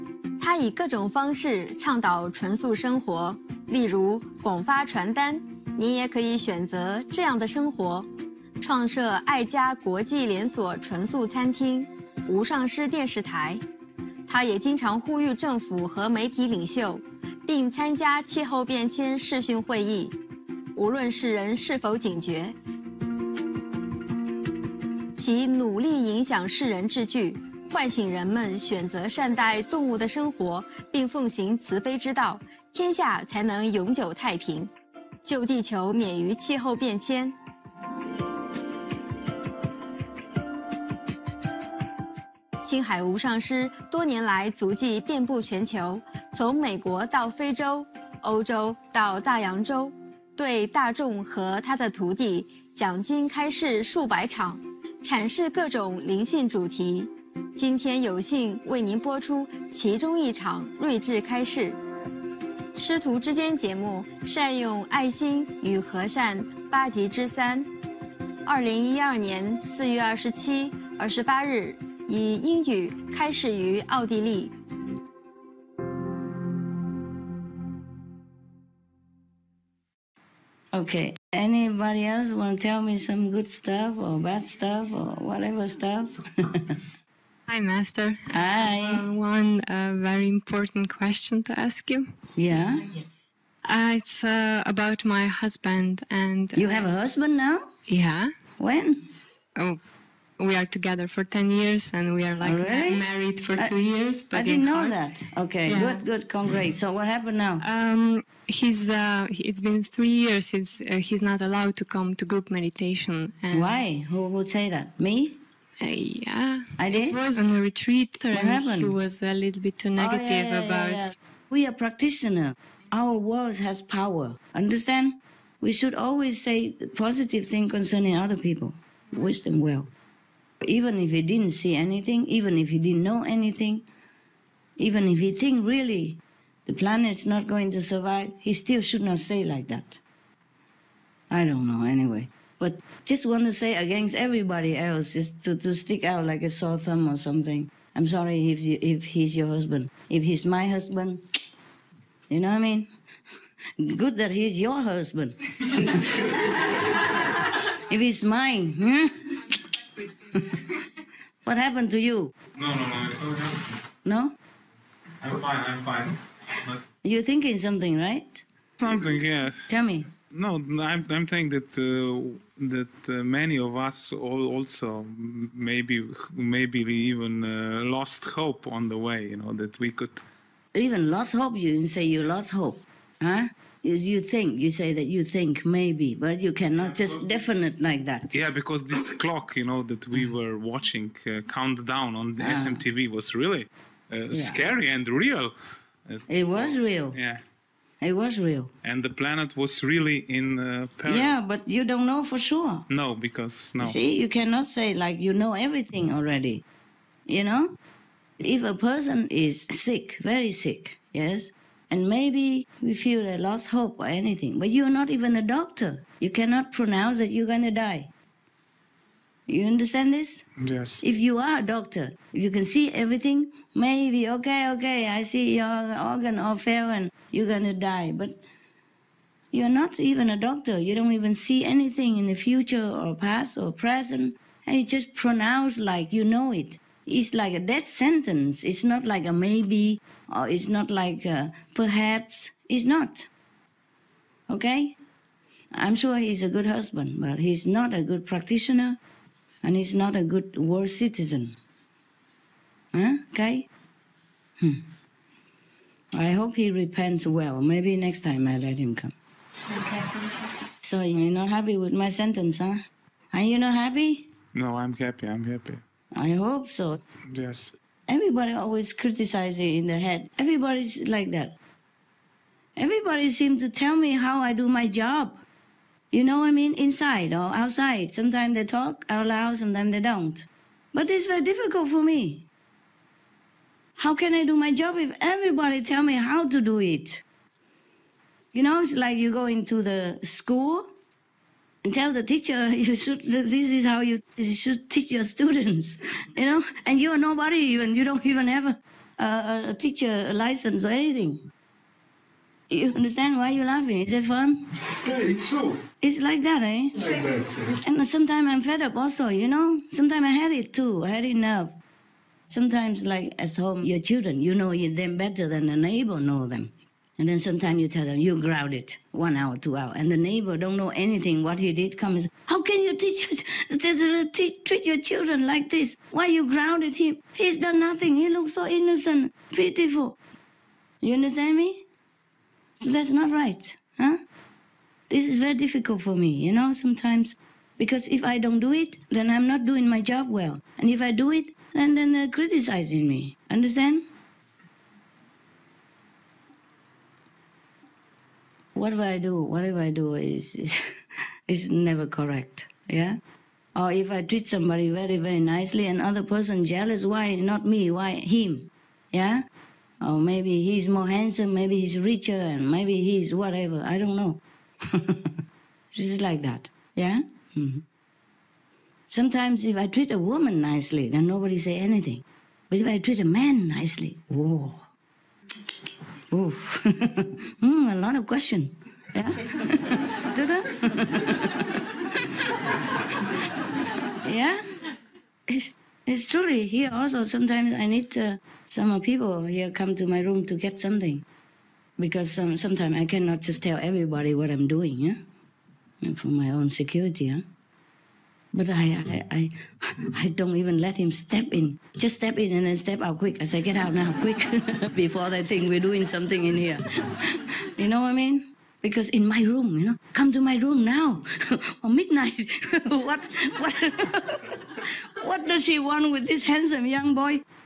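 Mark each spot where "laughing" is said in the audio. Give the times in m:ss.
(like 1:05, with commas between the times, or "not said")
5:03.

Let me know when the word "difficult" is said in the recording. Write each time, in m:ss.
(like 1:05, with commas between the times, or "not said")
4:41, 5:35.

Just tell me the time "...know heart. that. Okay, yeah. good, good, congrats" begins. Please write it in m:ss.
1:44.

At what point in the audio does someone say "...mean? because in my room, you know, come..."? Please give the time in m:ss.
6:48.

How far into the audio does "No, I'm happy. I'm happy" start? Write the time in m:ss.
4:24.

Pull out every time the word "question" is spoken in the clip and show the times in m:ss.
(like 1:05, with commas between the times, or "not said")
1:30, 6:18.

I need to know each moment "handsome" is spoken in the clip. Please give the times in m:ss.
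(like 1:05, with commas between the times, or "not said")
6:01, 6:56.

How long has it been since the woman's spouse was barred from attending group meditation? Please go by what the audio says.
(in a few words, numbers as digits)
three years.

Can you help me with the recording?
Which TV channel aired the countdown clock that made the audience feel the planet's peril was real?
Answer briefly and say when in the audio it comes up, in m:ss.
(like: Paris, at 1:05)
SMTV, at 3:12.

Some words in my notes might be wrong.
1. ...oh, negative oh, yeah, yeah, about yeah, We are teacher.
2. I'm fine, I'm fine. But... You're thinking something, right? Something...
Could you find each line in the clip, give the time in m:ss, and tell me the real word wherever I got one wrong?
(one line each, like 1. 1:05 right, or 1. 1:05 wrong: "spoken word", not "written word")
1. 1:59 wrong: "practitioner", not "teacher"
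2. 2:45 right.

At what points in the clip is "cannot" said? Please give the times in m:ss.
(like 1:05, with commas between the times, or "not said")
3:06, 3:24, 3:36, 6:33.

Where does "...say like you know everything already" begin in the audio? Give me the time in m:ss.
3:24.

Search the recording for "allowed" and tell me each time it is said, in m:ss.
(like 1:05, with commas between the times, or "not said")
1:51.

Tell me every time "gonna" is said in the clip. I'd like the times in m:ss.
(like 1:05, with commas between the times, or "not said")
3:37.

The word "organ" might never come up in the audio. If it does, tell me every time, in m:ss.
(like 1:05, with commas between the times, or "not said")
3:45.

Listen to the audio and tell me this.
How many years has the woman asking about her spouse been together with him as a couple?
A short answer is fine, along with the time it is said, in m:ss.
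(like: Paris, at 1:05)
10 years, at 1:41.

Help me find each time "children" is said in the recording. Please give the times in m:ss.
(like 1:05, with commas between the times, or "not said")
5:13, 5:24.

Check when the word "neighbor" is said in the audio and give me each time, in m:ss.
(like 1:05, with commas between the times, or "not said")
5:15, 5:20.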